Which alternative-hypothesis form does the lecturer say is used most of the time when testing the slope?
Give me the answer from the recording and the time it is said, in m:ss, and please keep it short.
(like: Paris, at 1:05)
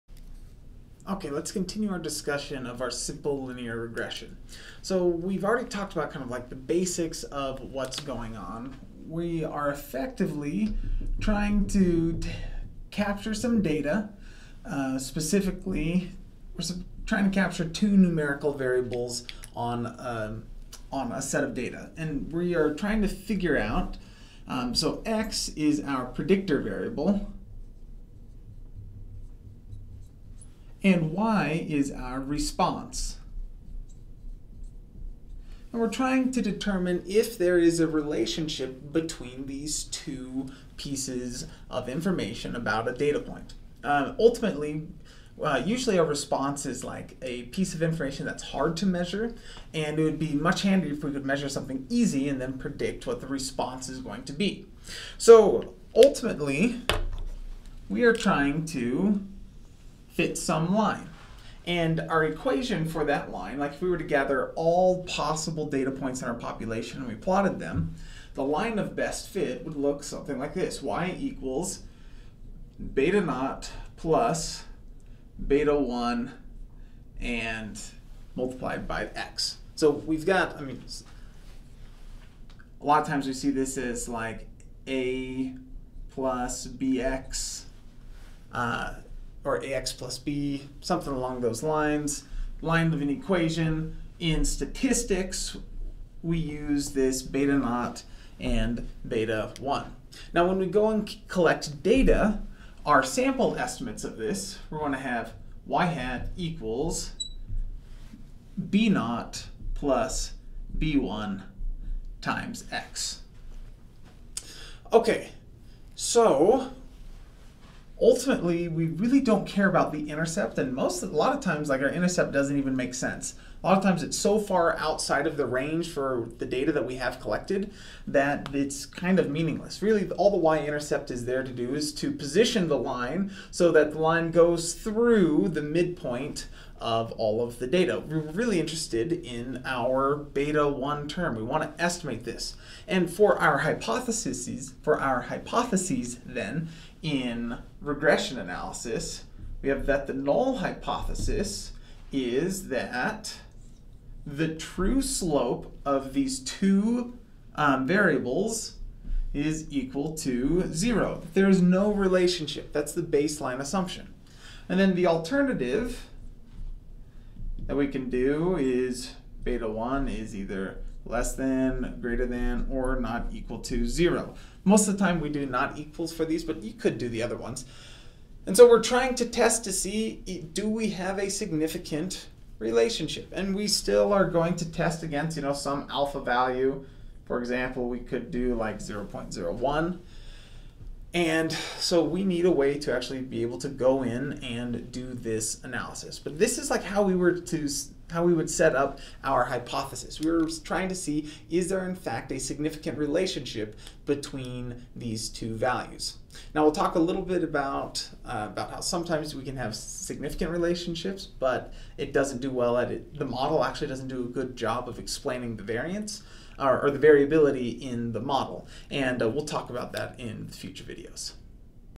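not equals, at 2:55.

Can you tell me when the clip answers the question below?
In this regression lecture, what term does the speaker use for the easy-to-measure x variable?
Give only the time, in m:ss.
0:26.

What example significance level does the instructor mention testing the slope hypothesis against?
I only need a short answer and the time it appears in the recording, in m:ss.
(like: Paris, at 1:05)
0.01, at 3:08.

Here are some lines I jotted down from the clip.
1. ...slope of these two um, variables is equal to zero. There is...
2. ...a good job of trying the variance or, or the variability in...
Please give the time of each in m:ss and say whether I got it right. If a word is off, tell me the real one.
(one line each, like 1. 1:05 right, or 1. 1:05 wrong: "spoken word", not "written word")
1. 2:35 right
2. 3:34 wrong: "explaining", not "trying".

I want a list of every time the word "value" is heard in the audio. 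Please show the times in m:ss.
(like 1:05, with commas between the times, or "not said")
3:06, 3:25.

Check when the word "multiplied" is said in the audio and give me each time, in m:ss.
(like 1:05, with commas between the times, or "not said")
1:18.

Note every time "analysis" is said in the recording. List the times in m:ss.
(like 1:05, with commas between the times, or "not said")
2:28, 3:15.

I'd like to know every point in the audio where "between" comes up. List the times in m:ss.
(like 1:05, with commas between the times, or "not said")
0:38, 3:24.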